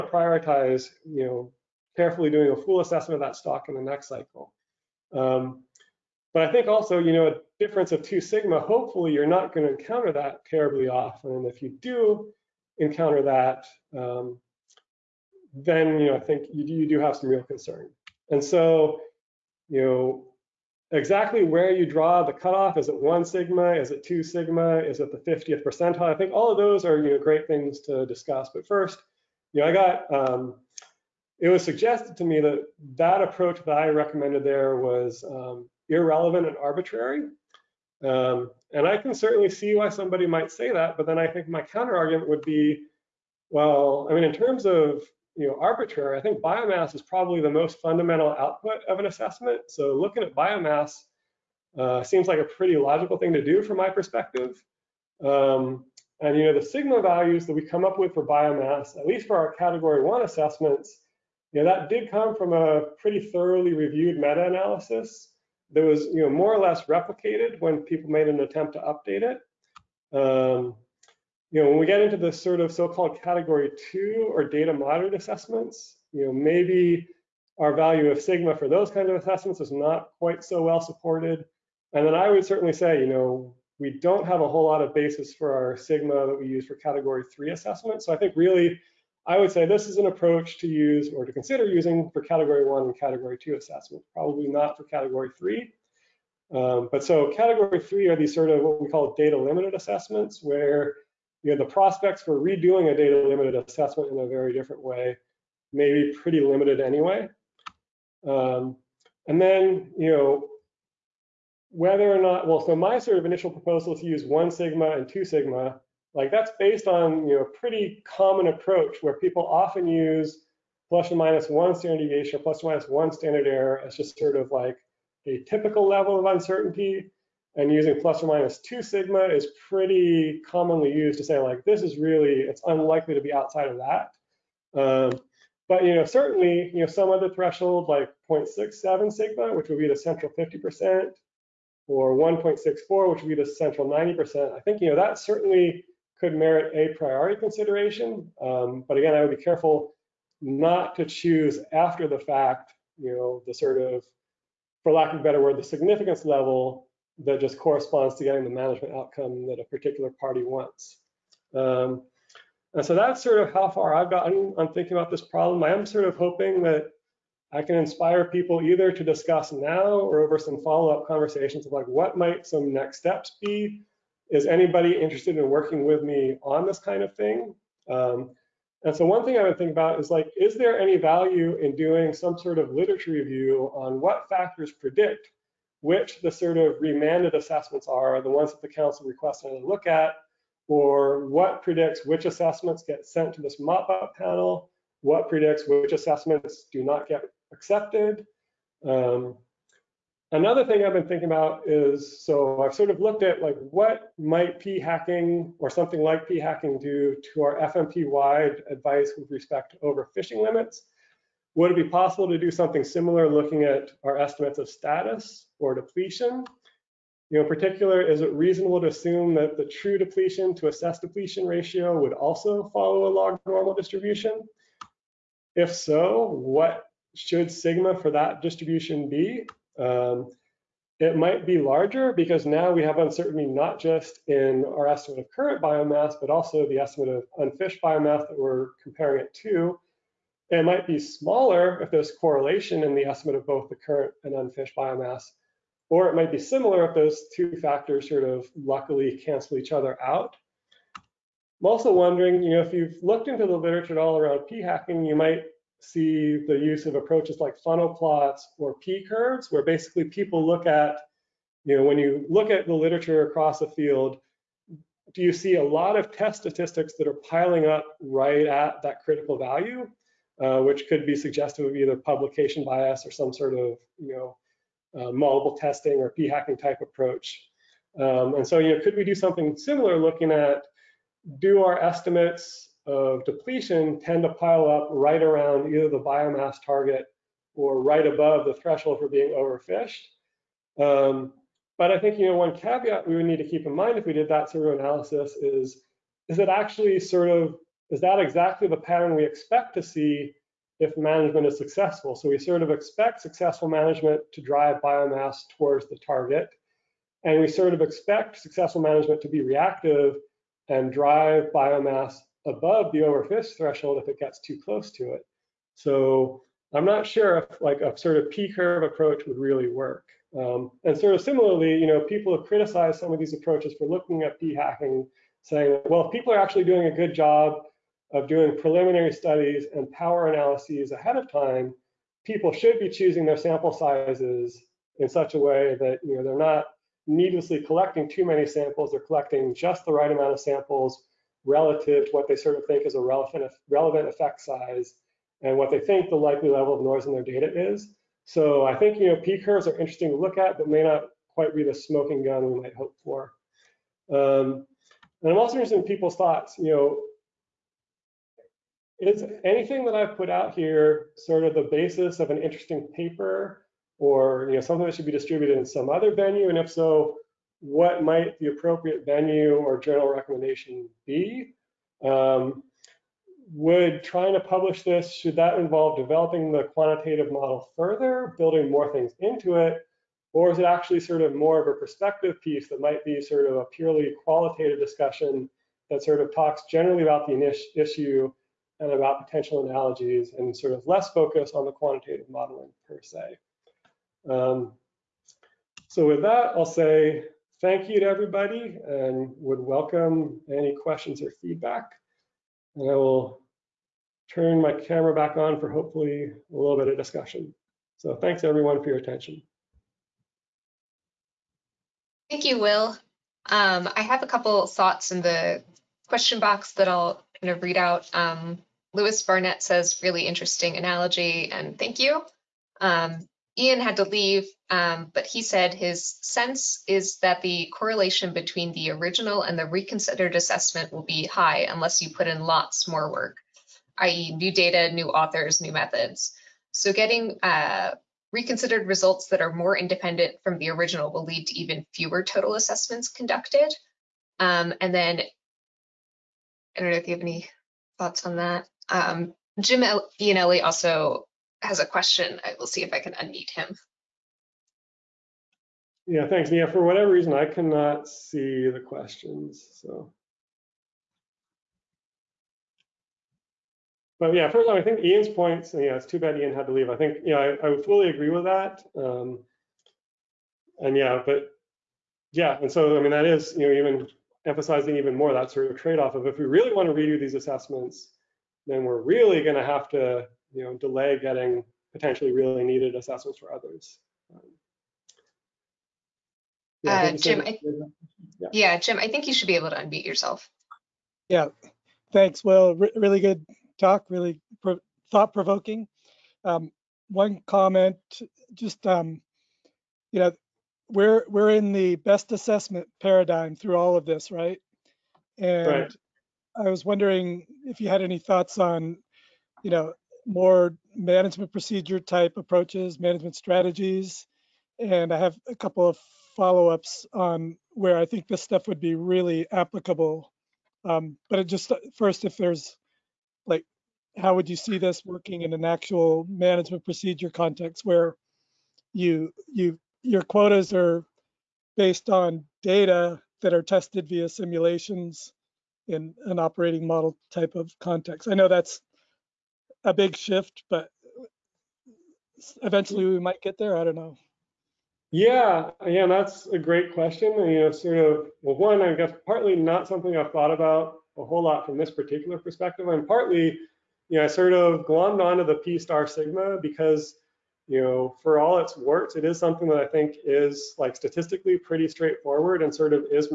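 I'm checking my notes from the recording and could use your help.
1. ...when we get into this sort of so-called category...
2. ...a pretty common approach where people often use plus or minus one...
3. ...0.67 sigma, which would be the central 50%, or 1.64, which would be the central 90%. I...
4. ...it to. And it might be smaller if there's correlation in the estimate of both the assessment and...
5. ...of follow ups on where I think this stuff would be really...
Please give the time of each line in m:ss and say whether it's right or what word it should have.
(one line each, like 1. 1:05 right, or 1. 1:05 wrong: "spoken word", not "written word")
1. 1:11 right
2. 1:57 right
3. 2:18 right
4. 3:59 wrong: "current", not "assessment"
5. 8:35 right.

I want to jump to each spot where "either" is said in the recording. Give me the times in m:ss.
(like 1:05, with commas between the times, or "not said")
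2:48, 4:31, 4:45.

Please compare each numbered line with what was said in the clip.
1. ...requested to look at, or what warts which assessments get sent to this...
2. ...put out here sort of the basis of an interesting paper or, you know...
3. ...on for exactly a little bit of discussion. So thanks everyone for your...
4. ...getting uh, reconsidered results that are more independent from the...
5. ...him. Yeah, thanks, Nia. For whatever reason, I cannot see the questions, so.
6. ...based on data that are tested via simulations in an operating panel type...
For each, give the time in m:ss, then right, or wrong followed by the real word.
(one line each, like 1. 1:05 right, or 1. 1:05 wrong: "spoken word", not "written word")
1. 3:09 wrong: "predicts", not "warts"
2. 6:00 right
3. 6:45 wrong: "hopefully", not "exactly"
4. 7:16 right
5. 7:33 right
6. 8:51 wrong: "model", not "panel".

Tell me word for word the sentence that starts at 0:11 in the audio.
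And if you do encounter that, um, then, you know, I think you, you do have some real concern.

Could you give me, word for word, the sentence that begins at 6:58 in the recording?
Um, Lewis Barnett says, really interesting analogy and thank you.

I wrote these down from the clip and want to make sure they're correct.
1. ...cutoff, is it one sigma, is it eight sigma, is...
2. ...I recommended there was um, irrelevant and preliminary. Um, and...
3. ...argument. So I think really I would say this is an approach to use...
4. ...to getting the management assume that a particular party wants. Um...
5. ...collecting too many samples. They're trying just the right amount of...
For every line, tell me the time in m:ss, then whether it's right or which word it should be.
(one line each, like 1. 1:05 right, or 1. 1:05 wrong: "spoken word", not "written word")
1. 0:22 wrong: "two", not "eight"
2. 0:33 wrong: "arbitrary", not "preliminary"
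3. 1:27 wrong: "assessment", not "argument"
4. 2:38 wrong: "outcome", not "assume"
5. 5:37 wrong: "collecting", not "trying".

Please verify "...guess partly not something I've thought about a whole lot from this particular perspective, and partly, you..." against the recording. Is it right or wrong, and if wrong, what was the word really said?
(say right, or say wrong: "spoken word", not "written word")
right.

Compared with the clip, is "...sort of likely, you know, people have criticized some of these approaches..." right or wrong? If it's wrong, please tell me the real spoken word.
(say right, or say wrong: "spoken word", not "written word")
wrong: "similarly", not "likely".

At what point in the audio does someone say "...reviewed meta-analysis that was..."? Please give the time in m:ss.
1:03.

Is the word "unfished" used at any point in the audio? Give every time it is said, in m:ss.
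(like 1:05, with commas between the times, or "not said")
3:57, 4:04.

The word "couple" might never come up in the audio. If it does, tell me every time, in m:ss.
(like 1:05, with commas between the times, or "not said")
6:54, 8:35.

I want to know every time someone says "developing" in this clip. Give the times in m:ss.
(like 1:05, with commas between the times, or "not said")
6:15.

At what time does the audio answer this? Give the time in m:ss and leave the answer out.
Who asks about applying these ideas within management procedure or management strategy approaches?
7:29.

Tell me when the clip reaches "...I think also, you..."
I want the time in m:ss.
0:06.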